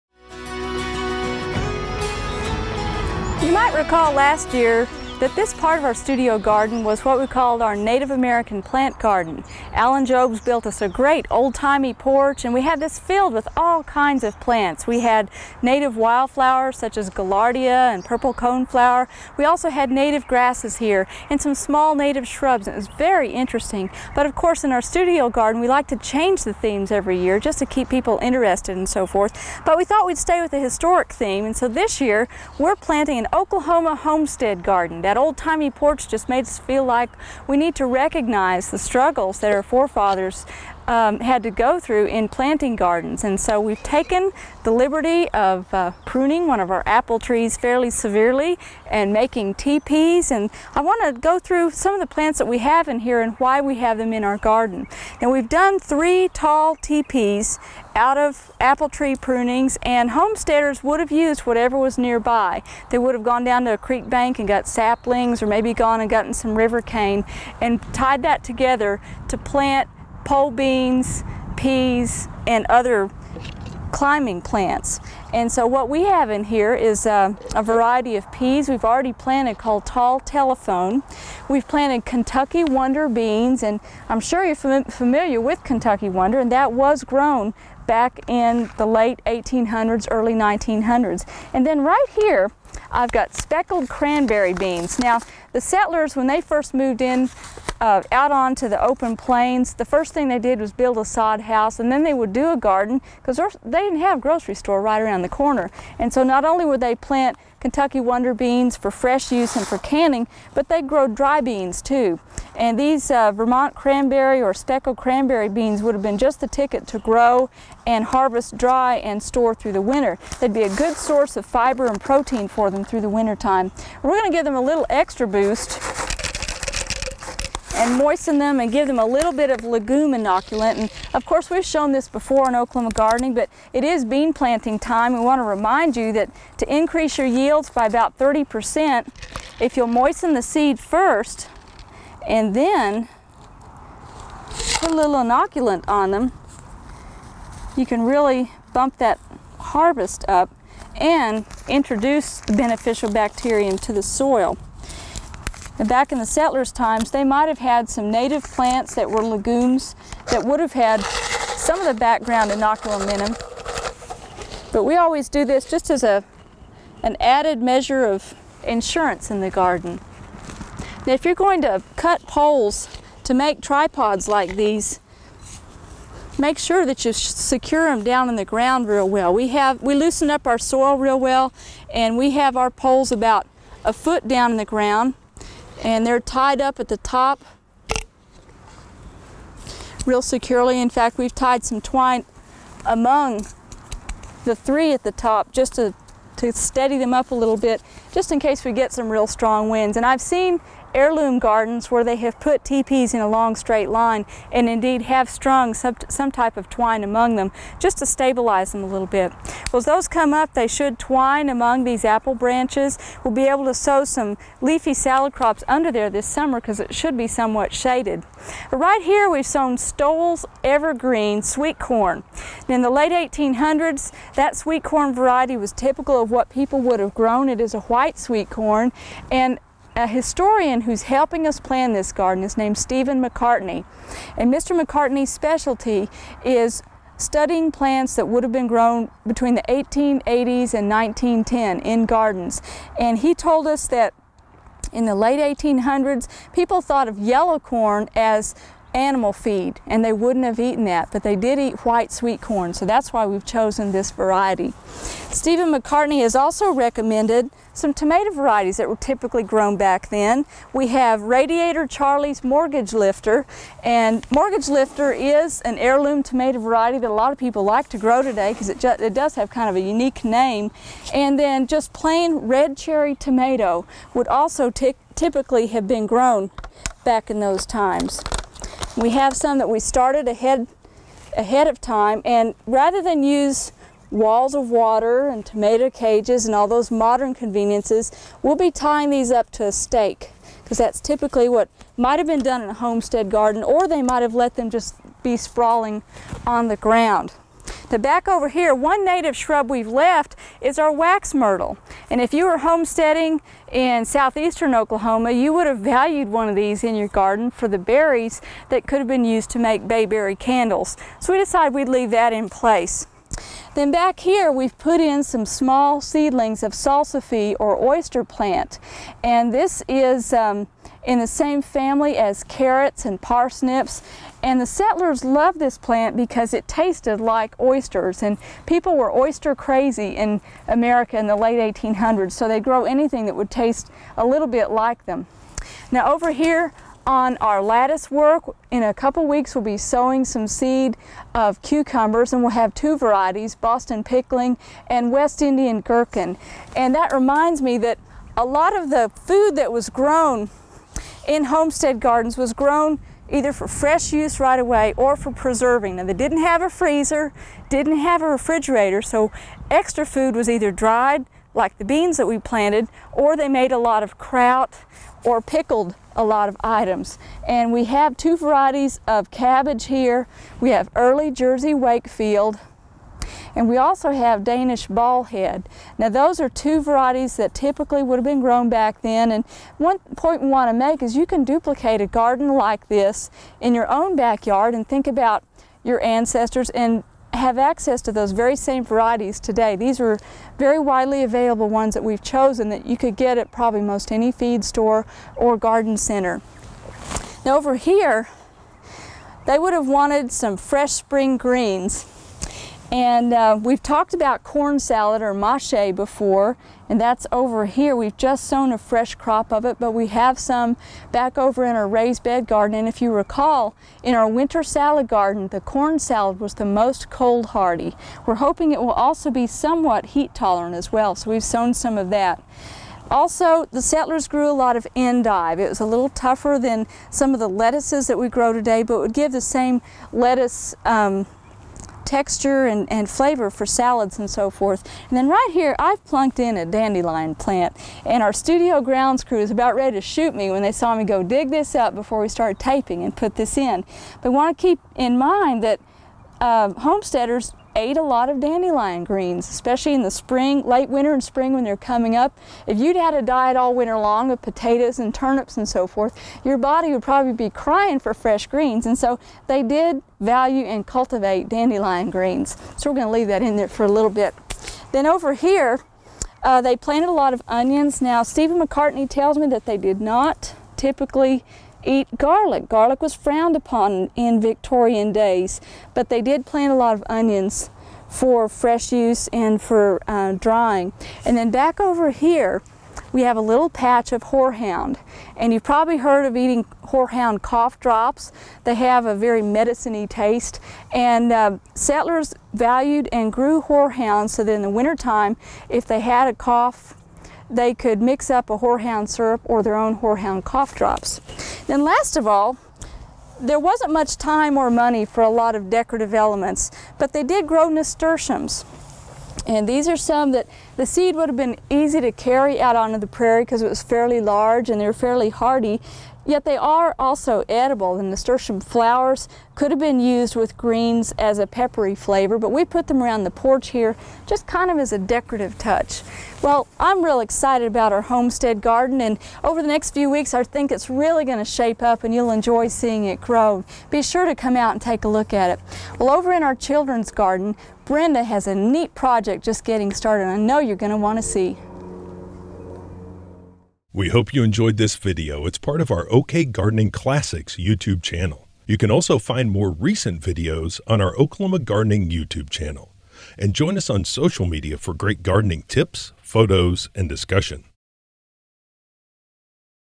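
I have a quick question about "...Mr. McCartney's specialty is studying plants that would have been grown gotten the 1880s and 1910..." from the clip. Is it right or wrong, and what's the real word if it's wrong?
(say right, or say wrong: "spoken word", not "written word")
wrong: "between", not "gotten".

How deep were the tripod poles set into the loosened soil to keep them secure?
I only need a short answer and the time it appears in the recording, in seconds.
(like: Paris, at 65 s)
a foot, at 183 s.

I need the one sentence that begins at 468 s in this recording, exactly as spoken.
Now, Stephen McCartney tells me that they did not typically eat garlic.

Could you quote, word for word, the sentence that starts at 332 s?
So they'd grow anything that would taste a little bit like them.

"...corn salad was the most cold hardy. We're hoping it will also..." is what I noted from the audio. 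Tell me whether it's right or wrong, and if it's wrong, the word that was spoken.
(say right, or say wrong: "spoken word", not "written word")
right.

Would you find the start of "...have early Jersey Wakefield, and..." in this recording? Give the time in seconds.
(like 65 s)
370 s.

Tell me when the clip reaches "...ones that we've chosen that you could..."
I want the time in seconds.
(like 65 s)
391 s.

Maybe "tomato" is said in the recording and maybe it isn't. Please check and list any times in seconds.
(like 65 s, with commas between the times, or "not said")
257 s, 266 s, 273 s, 285 s.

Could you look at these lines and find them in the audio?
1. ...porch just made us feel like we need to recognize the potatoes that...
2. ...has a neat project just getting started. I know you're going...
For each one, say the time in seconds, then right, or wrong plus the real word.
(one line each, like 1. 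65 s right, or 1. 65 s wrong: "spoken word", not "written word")
1. 35 s wrong: "struggles", not "potatoes"
2. 538 s right.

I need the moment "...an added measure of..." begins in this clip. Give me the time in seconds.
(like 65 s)
167 s.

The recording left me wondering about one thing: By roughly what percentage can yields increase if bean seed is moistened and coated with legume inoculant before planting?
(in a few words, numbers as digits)
30%.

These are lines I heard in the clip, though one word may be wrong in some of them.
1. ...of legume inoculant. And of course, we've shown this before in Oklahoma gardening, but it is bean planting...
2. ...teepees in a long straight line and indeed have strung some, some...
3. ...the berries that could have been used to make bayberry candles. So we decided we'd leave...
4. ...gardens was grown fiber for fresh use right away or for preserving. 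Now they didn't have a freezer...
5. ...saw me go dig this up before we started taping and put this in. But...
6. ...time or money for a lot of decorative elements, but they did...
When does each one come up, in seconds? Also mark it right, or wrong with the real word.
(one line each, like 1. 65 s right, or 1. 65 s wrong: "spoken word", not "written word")
1. 129 s right
2. 202 s right
3. 307 s right
4. 351 s wrong: "either", not "fiber"
5. 440 s right
6. 504 s right.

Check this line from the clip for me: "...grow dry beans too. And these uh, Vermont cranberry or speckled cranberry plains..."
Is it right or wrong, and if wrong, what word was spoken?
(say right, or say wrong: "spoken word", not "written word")
wrong: "beans", not "plains".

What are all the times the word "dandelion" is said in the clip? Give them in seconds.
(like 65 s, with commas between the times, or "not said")
436 s, 448 s, 461 s.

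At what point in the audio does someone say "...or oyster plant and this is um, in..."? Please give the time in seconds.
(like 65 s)
317 s.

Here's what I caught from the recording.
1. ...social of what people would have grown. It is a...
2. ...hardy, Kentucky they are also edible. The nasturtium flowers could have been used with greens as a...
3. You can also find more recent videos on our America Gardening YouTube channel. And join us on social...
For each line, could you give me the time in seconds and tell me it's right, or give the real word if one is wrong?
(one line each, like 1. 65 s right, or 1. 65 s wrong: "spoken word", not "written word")
1. 225 s wrong: "typical", not "social"
2. 515 s wrong: "Yet", not "Kentucky"
3. 548 s wrong: "Oklahoma", not "America".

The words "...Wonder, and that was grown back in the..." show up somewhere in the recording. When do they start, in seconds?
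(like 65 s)
86 s.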